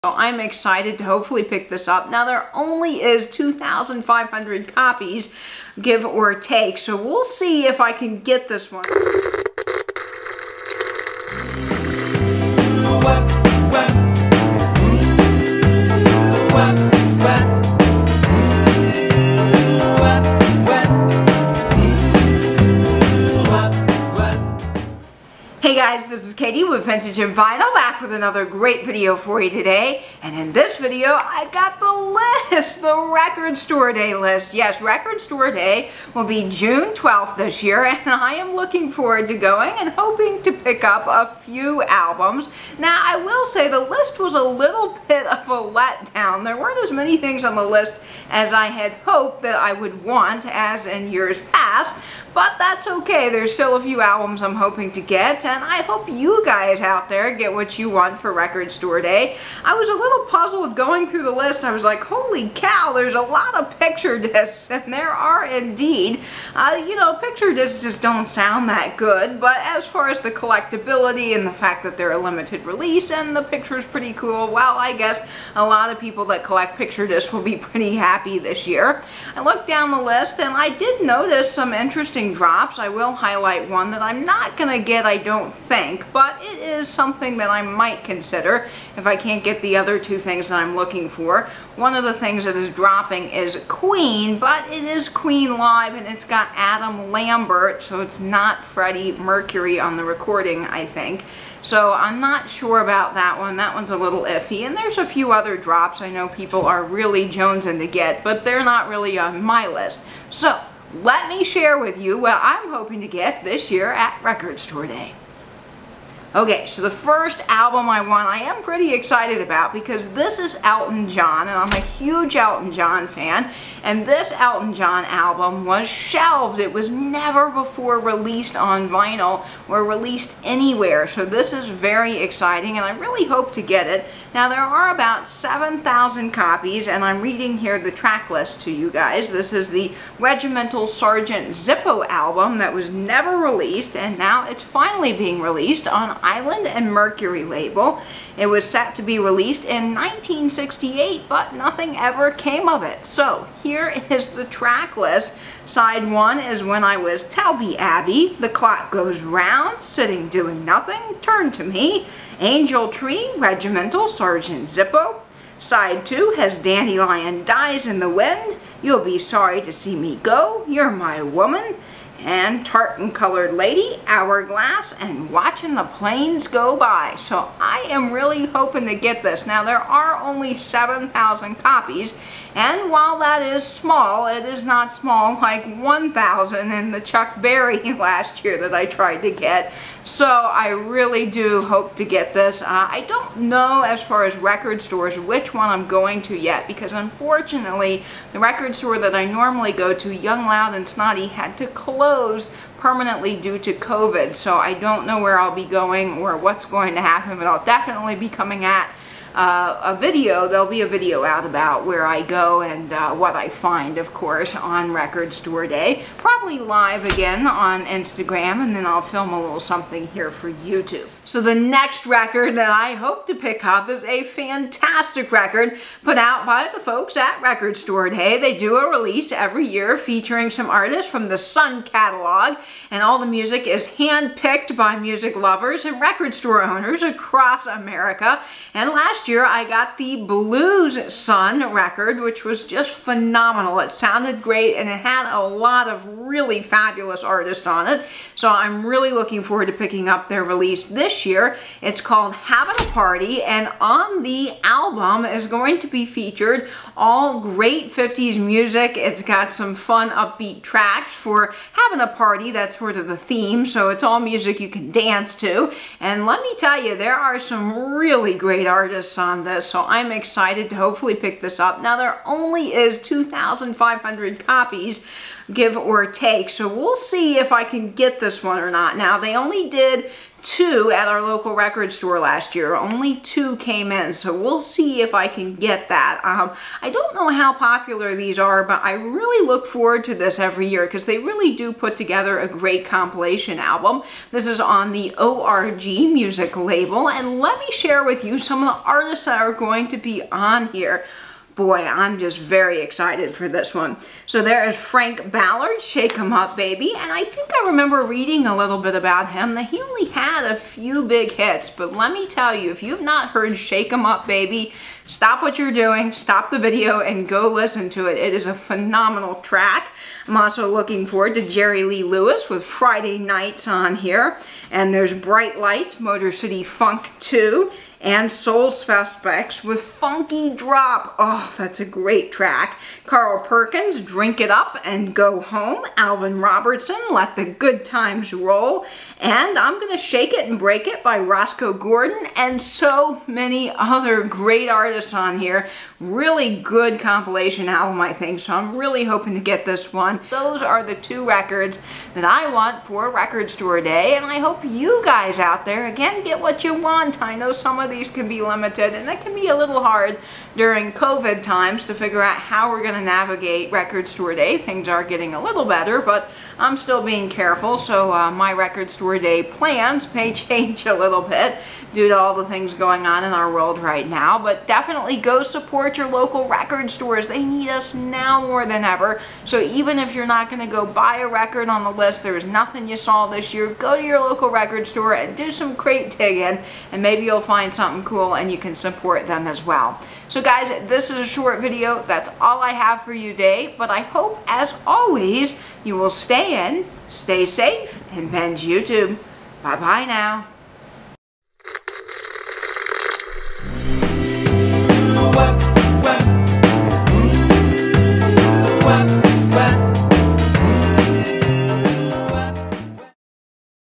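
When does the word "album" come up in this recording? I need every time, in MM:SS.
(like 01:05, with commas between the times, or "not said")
00:41, 00:53, 01:57, 02:05, 02:22, 04:14, 04:53, 05:47.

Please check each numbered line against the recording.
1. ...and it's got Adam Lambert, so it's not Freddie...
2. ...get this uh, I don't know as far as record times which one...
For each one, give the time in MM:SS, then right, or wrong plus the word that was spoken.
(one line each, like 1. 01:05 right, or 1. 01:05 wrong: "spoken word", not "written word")
1. 01:35 right
2. 03:12 wrong: "stores", not "times".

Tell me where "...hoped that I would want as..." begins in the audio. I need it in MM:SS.
00:49.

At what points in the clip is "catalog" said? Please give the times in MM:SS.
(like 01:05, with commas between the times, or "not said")
03:51.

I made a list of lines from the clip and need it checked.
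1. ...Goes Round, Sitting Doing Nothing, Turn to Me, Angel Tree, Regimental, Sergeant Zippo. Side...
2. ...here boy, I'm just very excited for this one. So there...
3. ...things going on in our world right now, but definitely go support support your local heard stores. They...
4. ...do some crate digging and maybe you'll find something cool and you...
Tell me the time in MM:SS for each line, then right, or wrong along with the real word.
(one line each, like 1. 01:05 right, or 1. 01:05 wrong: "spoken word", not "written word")
1. 02:38 right
2. 05:00 right
3. 06:12 wrong: "record", not "heard"
4. 06:25 right.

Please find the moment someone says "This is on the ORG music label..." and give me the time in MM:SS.
04:54.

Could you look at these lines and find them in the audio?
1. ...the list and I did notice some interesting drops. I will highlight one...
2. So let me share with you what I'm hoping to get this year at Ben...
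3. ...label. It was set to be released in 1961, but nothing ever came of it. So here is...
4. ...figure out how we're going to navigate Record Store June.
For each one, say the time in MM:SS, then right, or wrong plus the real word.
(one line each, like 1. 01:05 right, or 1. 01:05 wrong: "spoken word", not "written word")
1. 01:19 right
2. 01:50 wrong: "Record", not "Ben"
3. 02:27 wrong: "1968", not "1961"
4. 06:01 wrong: "Day", not "June".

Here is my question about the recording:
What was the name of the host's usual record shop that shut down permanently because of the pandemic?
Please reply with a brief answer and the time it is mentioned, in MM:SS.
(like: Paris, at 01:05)
Young Loud and Snotty, at 03:20.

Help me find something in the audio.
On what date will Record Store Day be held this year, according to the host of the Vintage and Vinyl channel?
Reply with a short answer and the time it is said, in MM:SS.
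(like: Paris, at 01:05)
June 12, at 00:36.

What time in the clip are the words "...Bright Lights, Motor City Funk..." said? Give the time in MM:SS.
05:25.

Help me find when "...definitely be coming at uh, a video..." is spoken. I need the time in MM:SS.
03:27.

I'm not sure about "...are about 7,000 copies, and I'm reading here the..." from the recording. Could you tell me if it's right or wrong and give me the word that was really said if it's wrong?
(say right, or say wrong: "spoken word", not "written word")
right.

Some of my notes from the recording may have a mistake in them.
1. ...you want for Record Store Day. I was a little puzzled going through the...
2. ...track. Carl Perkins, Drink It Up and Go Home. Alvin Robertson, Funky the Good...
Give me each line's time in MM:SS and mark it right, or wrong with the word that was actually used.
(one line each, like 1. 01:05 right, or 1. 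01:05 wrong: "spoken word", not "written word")
1. 00:57 right
2. 05:32 wrong: "Let", not "Funky".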